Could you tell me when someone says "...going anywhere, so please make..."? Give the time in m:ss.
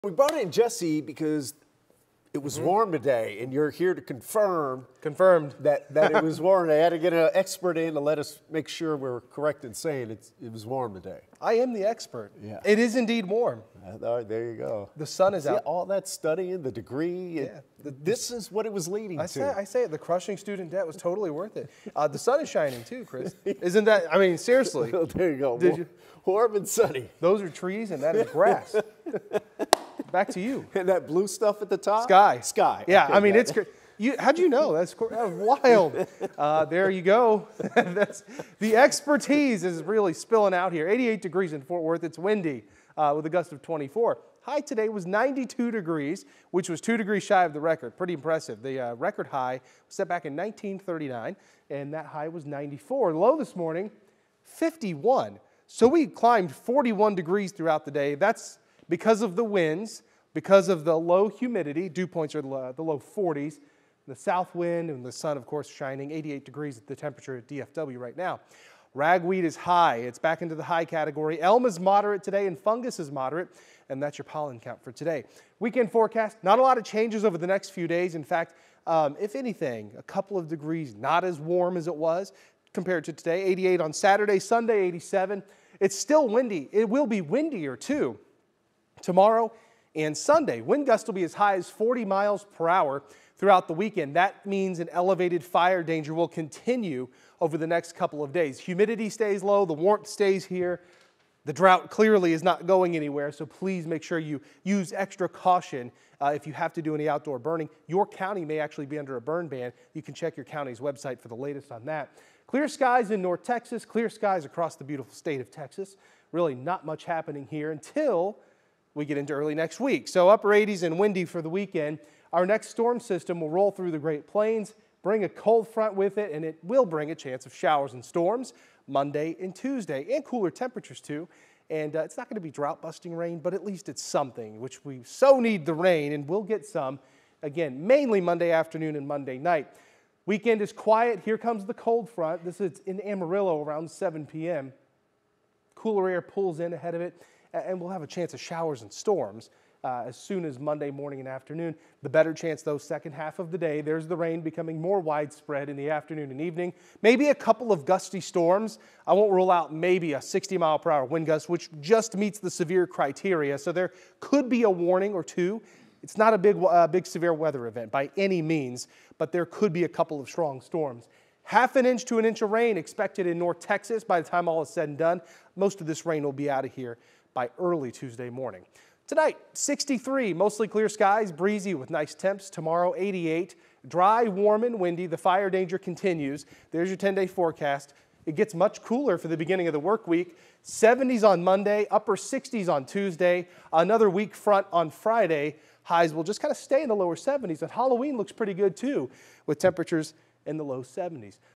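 1:42.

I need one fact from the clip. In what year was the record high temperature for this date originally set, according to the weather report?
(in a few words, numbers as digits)
1939.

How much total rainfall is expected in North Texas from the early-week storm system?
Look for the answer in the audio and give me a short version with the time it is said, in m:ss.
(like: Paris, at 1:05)
Half an inch to an inch, at 2:51.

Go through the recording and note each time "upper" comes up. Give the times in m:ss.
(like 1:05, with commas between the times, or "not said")
2:00, 3:11.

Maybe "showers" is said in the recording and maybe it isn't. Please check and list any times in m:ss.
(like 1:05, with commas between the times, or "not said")
2:07, 2:28.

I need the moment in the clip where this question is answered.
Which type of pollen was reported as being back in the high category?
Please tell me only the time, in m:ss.
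1:08.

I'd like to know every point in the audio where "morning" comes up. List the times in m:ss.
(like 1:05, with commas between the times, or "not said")
0:53, 2:30, 2:58.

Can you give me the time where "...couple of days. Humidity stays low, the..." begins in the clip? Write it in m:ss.
1:37.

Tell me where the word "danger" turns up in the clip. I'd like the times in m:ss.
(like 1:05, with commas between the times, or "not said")
1:35, 3:05.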